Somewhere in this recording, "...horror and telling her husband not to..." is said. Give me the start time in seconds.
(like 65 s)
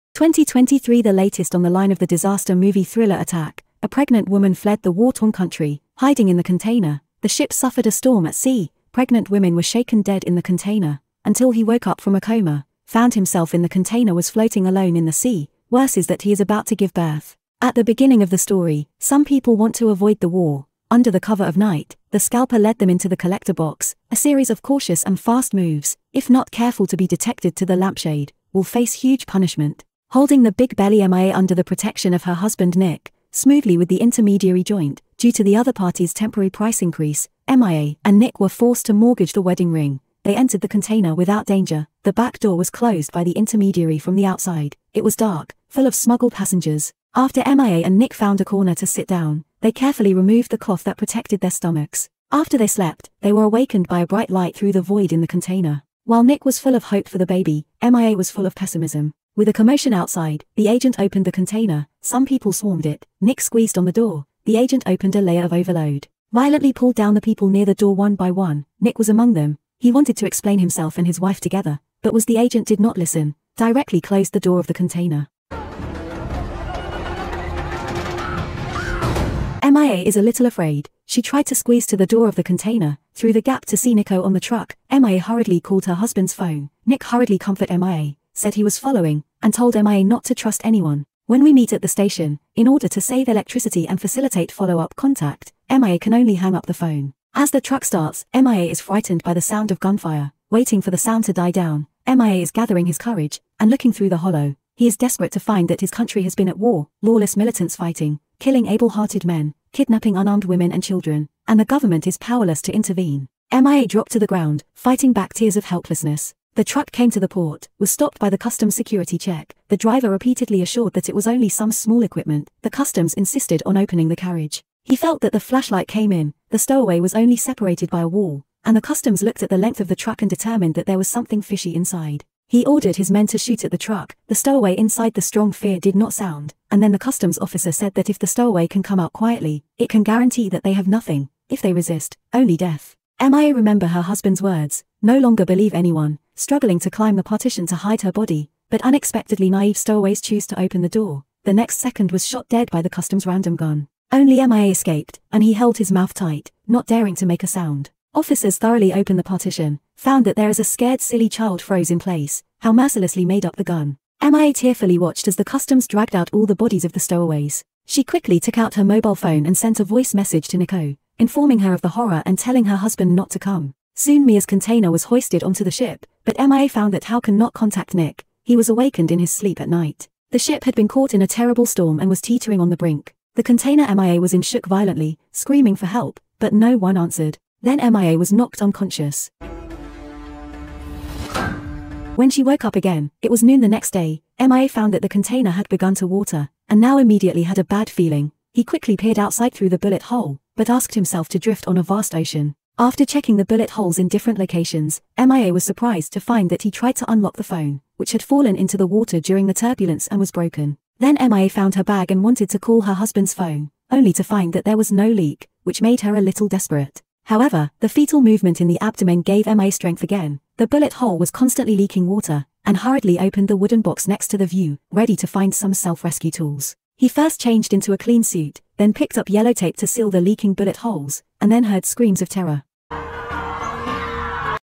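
171 s.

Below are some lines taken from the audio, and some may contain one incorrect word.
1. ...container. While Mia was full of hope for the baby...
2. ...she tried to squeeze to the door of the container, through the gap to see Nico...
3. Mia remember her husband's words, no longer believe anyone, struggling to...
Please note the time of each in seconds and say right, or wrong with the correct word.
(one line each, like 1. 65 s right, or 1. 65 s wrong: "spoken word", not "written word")
1. 55 s wrong: "Nick", not "Mia"
2. 81 s right
3. 143 s right.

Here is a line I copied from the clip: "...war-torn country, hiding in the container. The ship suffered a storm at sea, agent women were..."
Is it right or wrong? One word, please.
wrong.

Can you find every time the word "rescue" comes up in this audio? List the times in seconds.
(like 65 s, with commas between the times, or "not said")
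225 s.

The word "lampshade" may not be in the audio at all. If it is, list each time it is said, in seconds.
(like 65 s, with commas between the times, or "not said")
27 s.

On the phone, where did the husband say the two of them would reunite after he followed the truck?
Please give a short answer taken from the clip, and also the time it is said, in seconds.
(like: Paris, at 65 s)
The station, at 91 s.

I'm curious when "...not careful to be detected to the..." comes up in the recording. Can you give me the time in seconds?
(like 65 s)
26 s.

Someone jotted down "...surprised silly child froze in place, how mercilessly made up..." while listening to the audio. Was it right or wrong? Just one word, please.
wrong.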